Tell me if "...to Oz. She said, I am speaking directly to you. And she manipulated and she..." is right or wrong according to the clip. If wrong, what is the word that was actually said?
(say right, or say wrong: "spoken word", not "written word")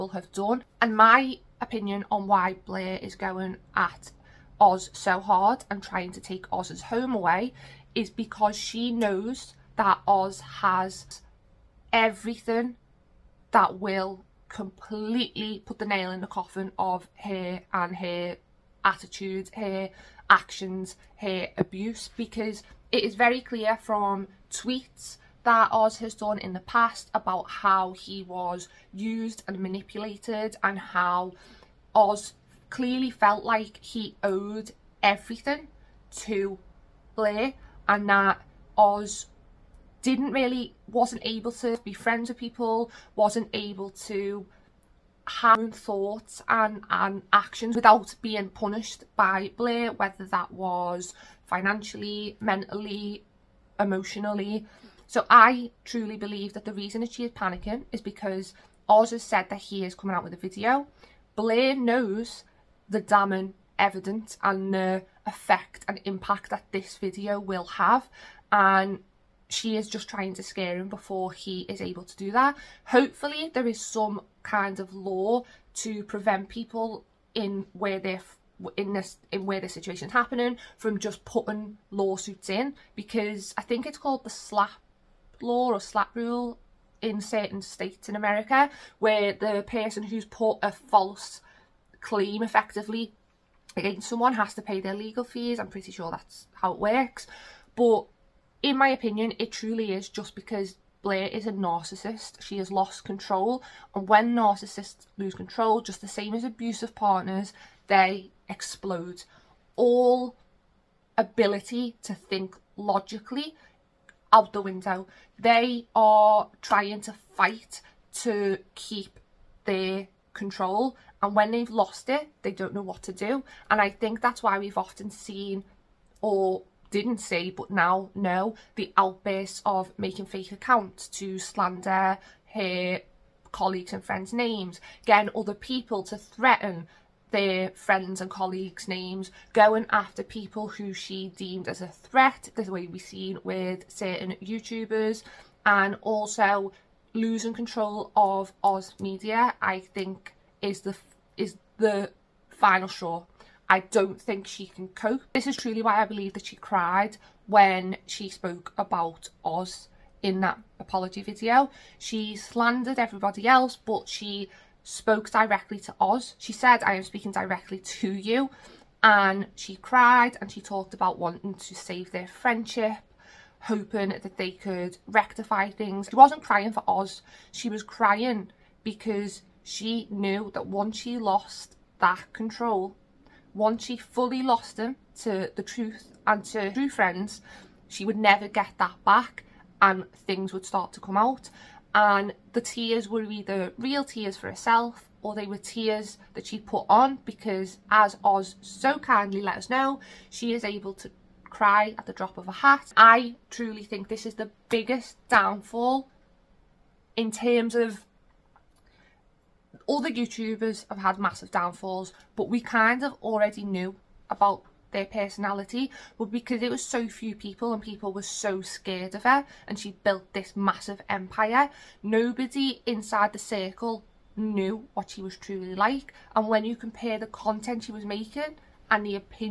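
wrong: "cried", not "manipulated".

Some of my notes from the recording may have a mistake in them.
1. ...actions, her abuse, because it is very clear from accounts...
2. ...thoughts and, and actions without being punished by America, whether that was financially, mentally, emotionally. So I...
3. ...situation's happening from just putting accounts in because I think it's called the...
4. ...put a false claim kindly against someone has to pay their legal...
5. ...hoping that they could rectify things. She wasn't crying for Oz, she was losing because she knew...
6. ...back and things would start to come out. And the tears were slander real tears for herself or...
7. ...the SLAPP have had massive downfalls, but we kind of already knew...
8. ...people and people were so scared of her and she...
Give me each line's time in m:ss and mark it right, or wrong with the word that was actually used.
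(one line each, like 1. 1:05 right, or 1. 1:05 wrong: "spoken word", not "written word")
1. 0:20 wrong: "tweets", not "accounts"
2. 0:45 wrong: "Blair", not "America"
3. 1:19 wrong: "lawsuits", not "accounts"
4. 1:30 wrong: "effectively", not "kindly"
5. 2:53 wrong: "crying", not "losing"
6. 3:09 wrong: "either", not "slander"
7. 3:30 wrong: "YouTubers", not "SLAPP"
8. 3:37 right.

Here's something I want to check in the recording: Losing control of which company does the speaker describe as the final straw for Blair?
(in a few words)
Oz Media.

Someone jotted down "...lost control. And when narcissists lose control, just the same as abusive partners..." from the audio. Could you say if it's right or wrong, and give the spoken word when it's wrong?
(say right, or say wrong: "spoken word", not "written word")
right.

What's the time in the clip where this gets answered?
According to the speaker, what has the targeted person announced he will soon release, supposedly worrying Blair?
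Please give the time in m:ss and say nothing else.
1:00.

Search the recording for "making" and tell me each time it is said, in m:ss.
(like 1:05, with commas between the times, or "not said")
2:09, 3:48.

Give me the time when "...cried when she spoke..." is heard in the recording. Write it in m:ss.
2:36.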